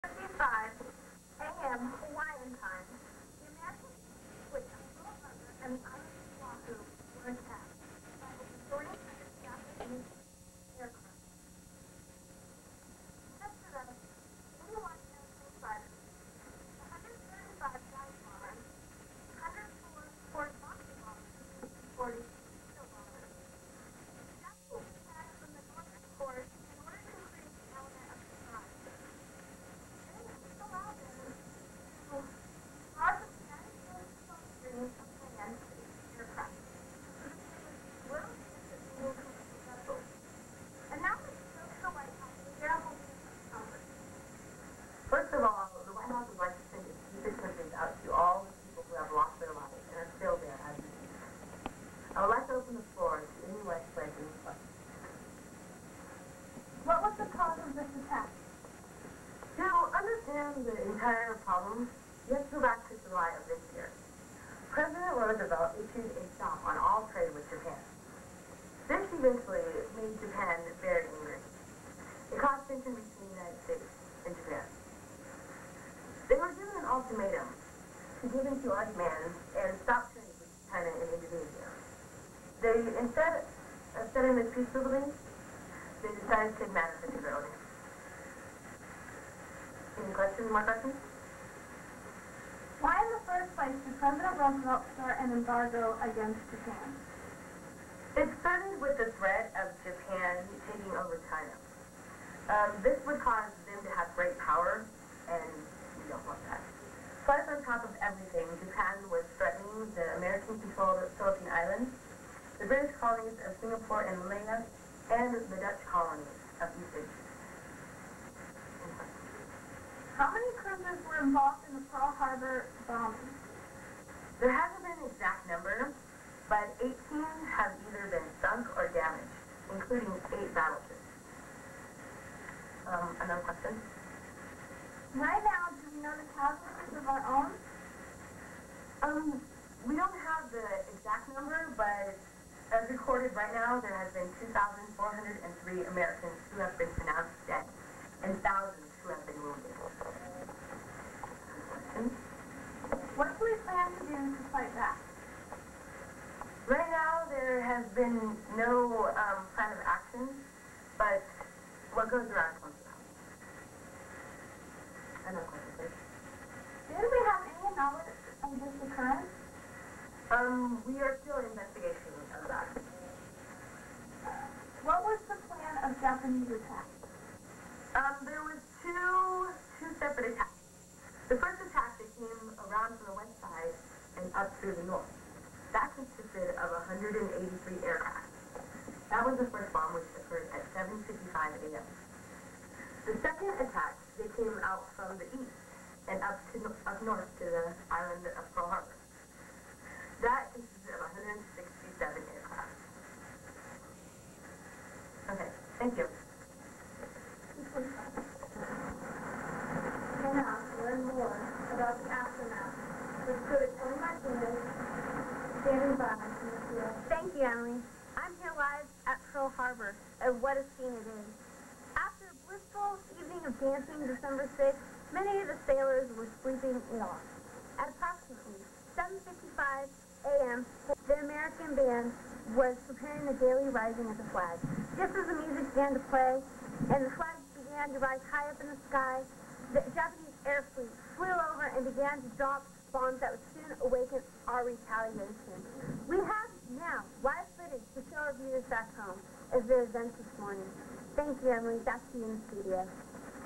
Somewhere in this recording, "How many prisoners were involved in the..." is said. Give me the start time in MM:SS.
02:00.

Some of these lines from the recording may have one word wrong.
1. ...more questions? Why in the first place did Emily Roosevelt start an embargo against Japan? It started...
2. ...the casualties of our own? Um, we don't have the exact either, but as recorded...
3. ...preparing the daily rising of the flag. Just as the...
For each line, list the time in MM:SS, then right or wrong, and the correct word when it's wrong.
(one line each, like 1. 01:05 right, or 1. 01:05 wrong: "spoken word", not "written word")
1. 01:30 wrong: "President", not "Emily"
2. 02:16 wrong: "number", not "either"
3. 03:52 right.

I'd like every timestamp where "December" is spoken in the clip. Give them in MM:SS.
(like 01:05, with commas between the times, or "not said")
03:44.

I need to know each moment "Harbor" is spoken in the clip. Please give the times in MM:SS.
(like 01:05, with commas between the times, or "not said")
02:02, 03:39.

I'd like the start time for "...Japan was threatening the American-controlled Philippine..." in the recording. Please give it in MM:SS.
01:48.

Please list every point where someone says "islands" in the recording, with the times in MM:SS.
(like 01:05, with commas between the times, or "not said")
01:51, 03:17.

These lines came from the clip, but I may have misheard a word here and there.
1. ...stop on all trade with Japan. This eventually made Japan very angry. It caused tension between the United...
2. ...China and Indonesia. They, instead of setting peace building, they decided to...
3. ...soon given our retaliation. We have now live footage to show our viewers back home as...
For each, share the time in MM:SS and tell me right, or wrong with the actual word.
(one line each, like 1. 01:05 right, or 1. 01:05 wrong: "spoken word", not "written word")
1. 01:06 right
2. 01:20 right
3. 04:03 wrong: "awaken", not "given".